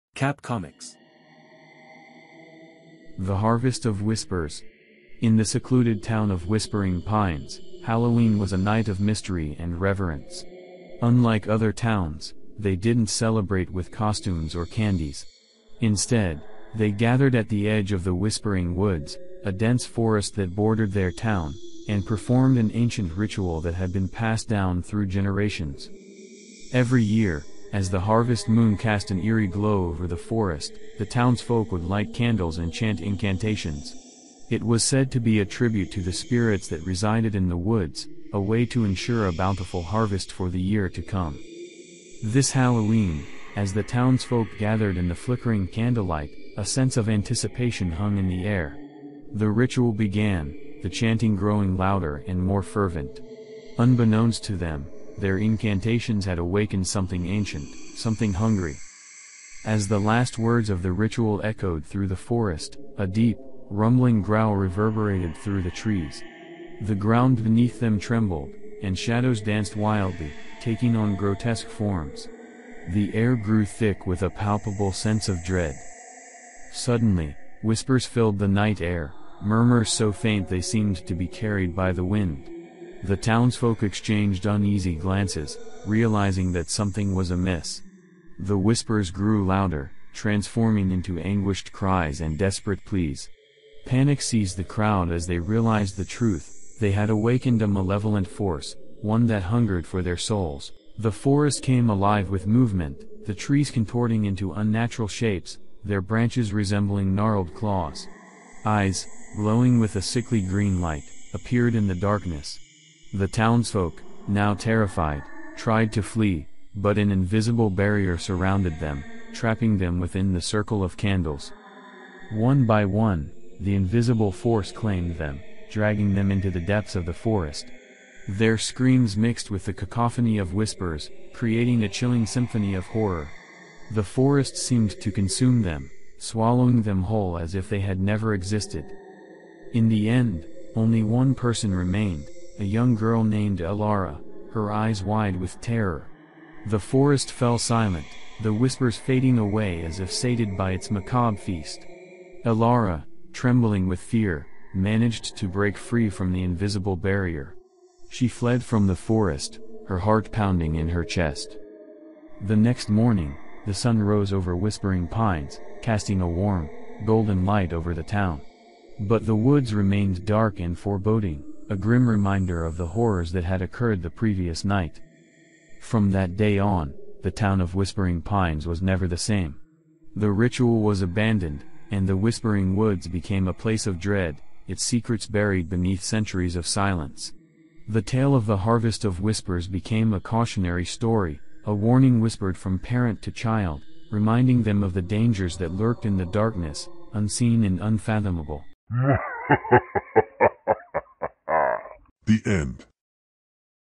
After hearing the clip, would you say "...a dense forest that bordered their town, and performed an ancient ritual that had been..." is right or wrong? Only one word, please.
right.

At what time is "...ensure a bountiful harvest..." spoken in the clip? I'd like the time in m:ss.
0:38.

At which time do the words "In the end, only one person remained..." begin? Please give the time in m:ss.
2:19.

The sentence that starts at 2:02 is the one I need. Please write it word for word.
One by one, the invisible force claimed them, dragging them into the depths of the forest.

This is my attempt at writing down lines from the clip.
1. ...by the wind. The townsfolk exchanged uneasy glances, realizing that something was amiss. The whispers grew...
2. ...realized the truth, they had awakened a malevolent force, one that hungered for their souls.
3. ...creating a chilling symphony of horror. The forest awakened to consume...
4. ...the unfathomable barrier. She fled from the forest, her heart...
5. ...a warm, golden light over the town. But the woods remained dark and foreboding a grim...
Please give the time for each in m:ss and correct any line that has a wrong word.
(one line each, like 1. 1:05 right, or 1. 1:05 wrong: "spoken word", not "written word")
1. 1:21 right
2. 1:35 right
3. 2:11 wrong: "seemed", not "awakened"
4. 2:36 wrong: "invisible", not "unfathomable"
5. 2:46 right.